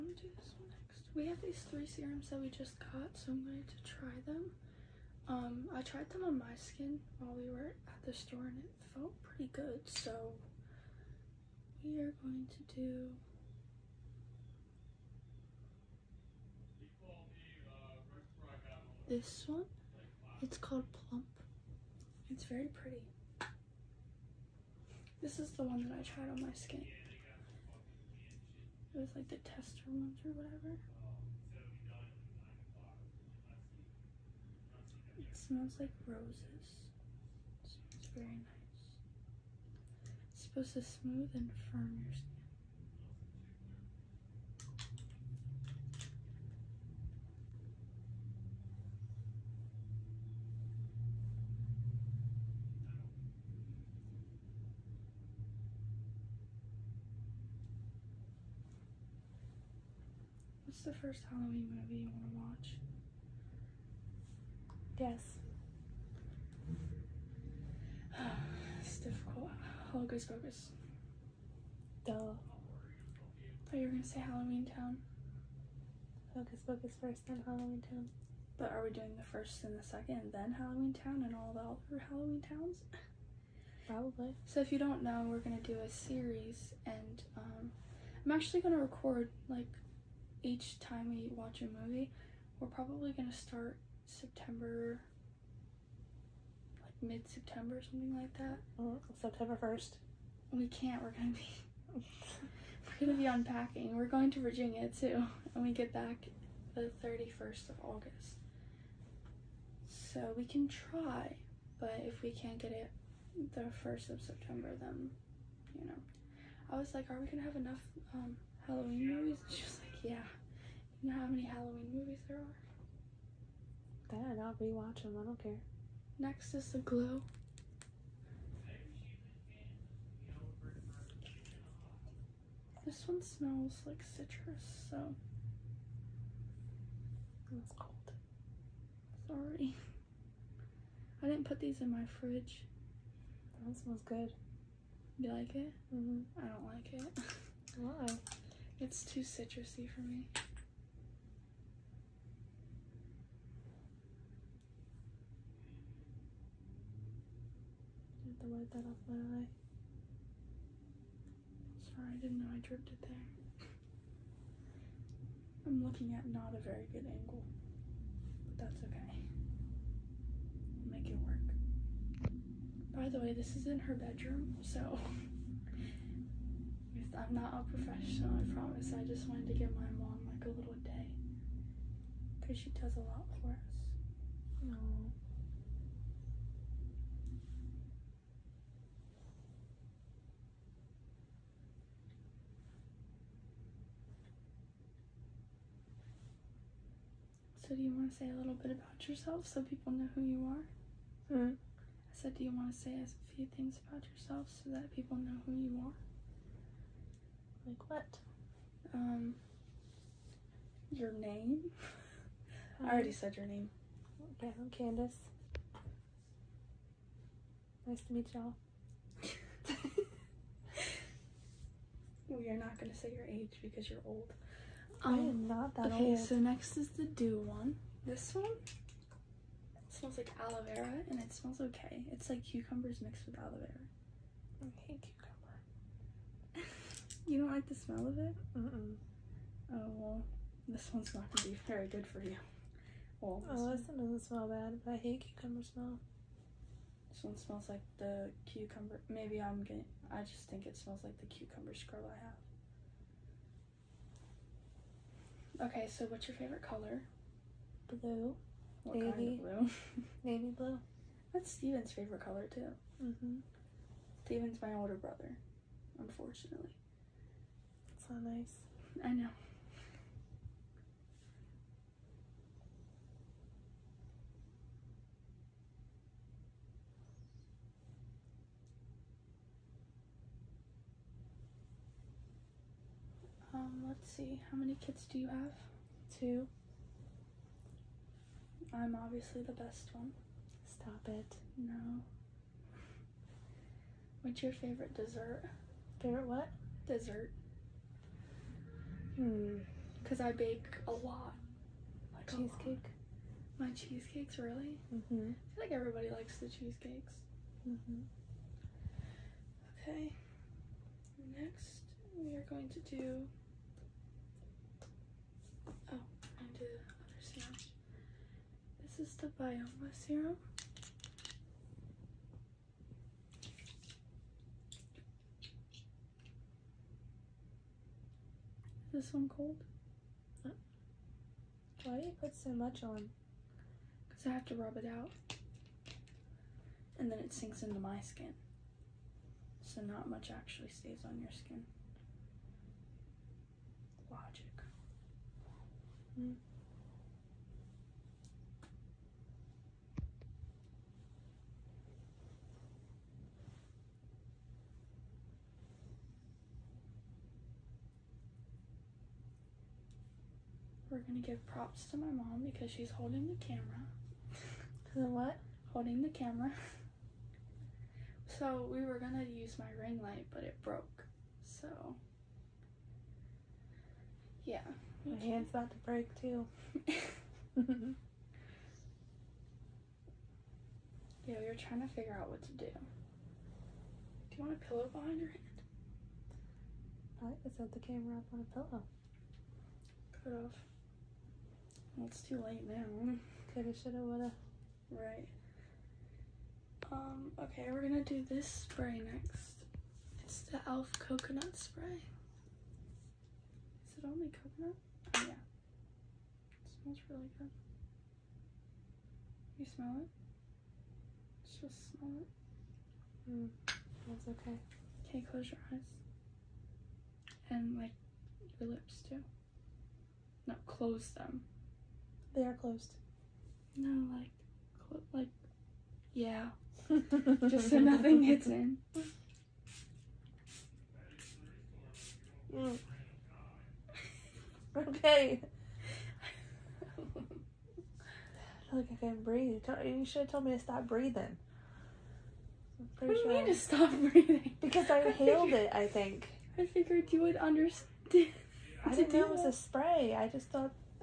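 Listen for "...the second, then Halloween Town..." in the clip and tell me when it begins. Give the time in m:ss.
1:19.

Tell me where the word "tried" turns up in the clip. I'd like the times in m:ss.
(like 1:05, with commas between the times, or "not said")
0:05, 0:26.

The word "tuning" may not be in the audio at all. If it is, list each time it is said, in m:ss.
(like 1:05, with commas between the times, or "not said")
not said.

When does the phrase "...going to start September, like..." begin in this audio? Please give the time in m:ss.
1:33.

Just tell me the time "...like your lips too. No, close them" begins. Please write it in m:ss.
6:57.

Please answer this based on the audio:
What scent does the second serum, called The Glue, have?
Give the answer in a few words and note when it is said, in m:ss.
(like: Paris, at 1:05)
Citrus, at 2:12.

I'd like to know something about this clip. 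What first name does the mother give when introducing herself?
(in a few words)
Candace.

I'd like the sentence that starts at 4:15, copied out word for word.
Okay, so what's your favorite color?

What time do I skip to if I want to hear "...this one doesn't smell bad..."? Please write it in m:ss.
4:03.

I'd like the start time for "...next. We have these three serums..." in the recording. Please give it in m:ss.
0:00.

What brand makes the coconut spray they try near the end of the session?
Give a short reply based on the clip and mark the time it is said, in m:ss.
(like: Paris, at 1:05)
e.l.f., at 6:40.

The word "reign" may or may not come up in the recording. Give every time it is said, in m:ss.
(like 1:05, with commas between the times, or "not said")
not said.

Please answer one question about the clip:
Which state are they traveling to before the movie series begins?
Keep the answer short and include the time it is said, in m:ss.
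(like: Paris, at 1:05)
Virginia, at 1:43.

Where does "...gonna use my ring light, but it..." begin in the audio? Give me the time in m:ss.
6:08.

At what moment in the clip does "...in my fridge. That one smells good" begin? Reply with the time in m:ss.
2:21.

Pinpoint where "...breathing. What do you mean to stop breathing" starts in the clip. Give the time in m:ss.
7:20.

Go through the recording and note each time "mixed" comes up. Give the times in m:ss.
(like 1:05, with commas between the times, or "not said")
3:53.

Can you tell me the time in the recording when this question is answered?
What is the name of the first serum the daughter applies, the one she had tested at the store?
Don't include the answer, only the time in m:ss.
0:20.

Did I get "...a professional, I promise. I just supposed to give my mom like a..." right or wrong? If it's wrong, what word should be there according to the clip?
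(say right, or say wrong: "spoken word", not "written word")
wrong: "wanted", not "supposed".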